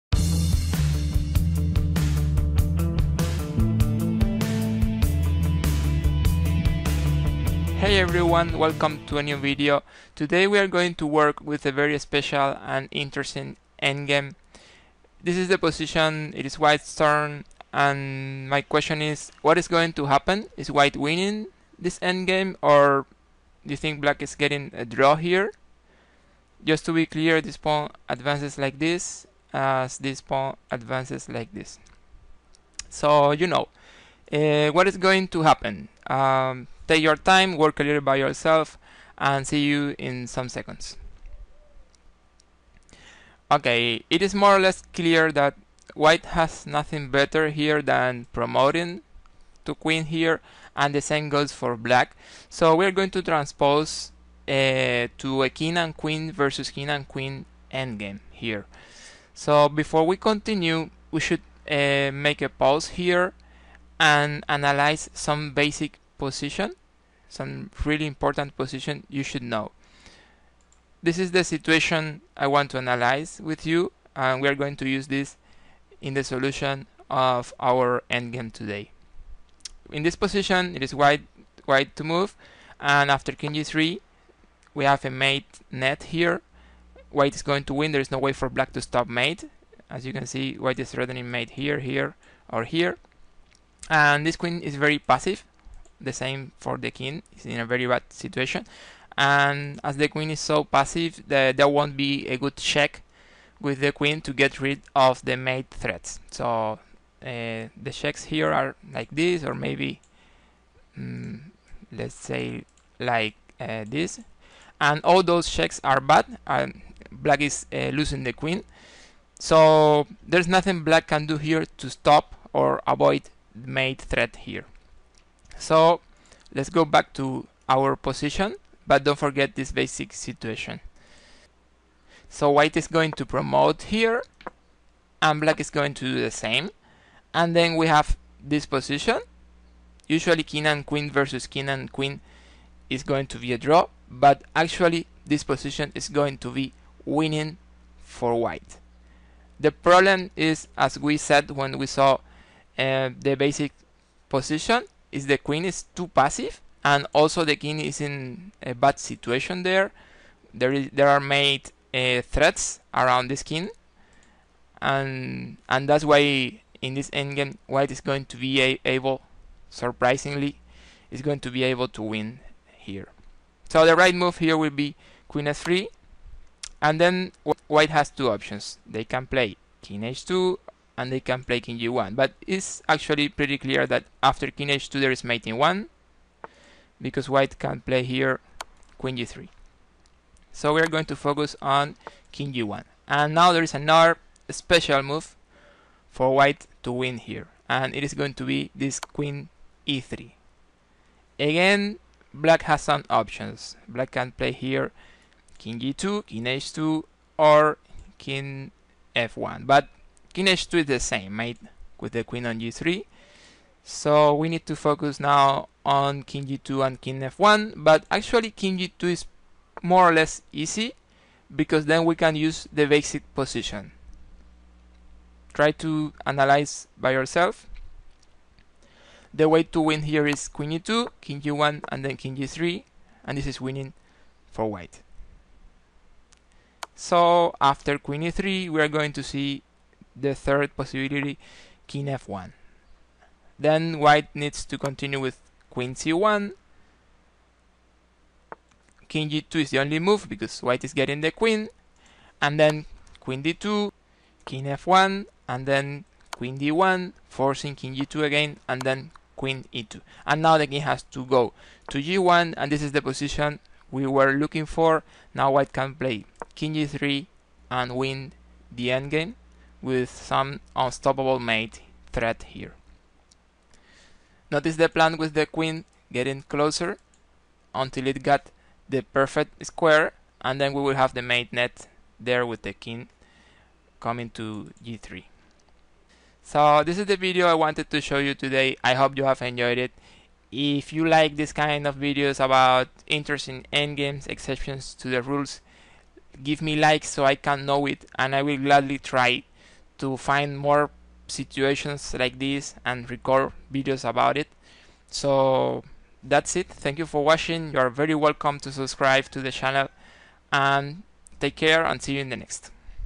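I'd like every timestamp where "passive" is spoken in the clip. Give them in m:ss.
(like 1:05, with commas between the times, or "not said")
1:34, 1:40, 2:36.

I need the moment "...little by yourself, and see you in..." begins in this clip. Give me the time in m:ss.
0:37.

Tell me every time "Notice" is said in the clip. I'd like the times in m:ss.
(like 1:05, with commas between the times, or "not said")
4:34.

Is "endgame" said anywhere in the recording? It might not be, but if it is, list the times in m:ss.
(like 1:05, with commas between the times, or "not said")
0:13, 0:21, 0:57, 1:18, 2:47, 4:28, 4:53.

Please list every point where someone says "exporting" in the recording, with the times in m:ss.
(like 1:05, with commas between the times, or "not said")
not said.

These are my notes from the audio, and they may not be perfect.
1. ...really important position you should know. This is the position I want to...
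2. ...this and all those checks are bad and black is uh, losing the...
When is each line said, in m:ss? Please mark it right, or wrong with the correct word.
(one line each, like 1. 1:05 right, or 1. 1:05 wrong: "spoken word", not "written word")
1. 1:07 wrong: "situation", not "position"
2. 1:53 right.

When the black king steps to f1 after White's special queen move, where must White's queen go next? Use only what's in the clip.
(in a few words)
Queen c1.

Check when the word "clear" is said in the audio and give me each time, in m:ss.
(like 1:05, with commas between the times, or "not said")
0:27, 0:44, 3:03.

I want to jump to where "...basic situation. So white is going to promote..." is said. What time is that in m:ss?
2:09.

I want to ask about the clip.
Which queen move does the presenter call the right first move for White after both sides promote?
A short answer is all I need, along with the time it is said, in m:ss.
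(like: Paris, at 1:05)
Queen f3, at 2:55.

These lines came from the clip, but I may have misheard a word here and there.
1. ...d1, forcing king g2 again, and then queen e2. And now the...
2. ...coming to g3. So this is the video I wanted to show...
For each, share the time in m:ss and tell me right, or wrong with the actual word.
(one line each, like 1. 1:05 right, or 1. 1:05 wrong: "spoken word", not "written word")
1. 4:16 right
2. 4:43 right.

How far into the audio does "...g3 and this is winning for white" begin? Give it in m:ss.
3:52.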